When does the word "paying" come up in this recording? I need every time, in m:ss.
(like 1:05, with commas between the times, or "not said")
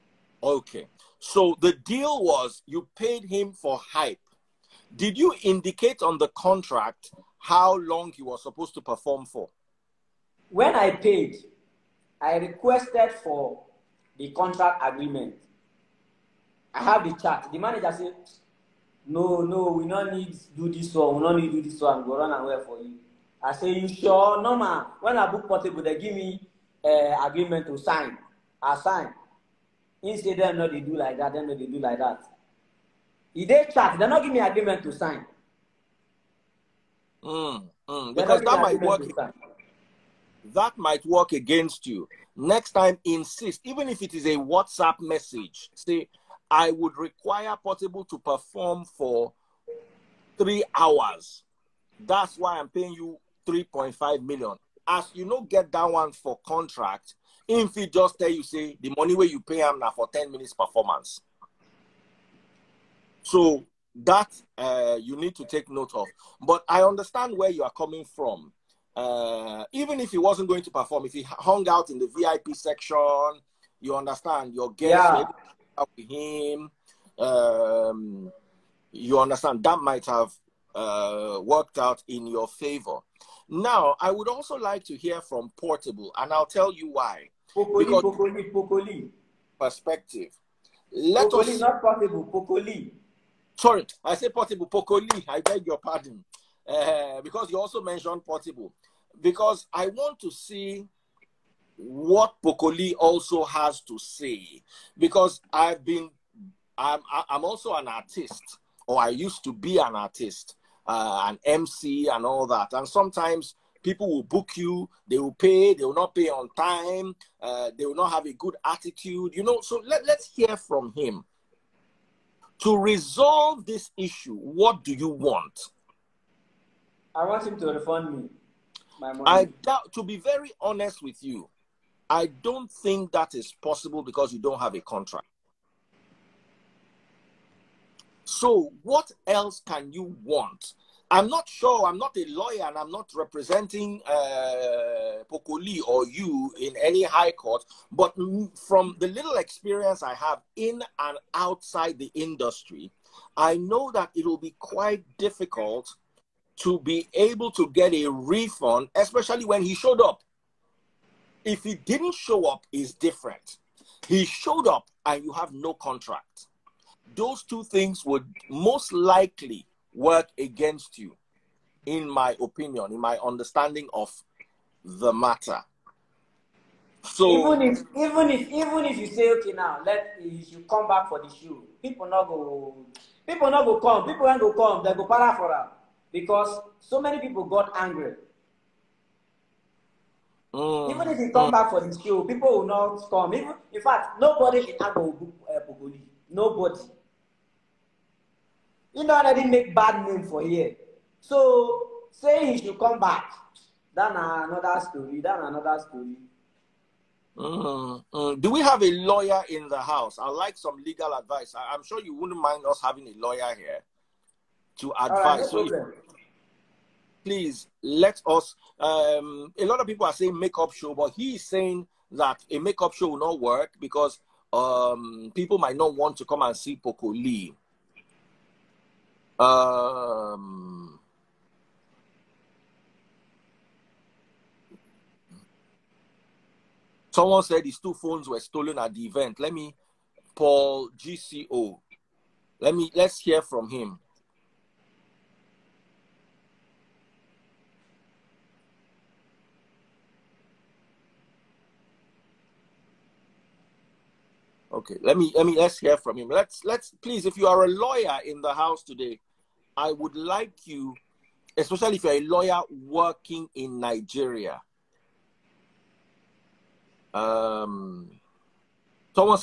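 0:52.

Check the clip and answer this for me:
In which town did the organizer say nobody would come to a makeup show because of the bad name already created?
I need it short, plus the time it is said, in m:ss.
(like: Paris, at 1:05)
Agbor, at 3:14.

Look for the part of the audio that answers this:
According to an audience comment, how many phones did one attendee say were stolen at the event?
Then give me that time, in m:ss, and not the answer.
3:57.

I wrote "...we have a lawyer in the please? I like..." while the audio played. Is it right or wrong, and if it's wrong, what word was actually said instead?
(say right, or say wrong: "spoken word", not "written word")
wrong: "house", not "please".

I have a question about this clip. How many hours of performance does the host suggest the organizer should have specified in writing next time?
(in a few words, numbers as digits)
3 hours.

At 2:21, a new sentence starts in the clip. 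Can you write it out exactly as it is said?
I'm not a lawyer, and I'm not representing uh, Poco Lee or you in any high court.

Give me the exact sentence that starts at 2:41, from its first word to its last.
If he didn't show up, is different.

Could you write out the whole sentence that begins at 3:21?
So saying he should come back, that's another story.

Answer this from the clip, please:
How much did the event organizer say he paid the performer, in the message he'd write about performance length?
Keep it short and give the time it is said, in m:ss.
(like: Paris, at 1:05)
3.5 million, at 0:53.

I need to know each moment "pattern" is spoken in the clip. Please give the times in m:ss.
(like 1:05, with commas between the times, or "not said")
not said.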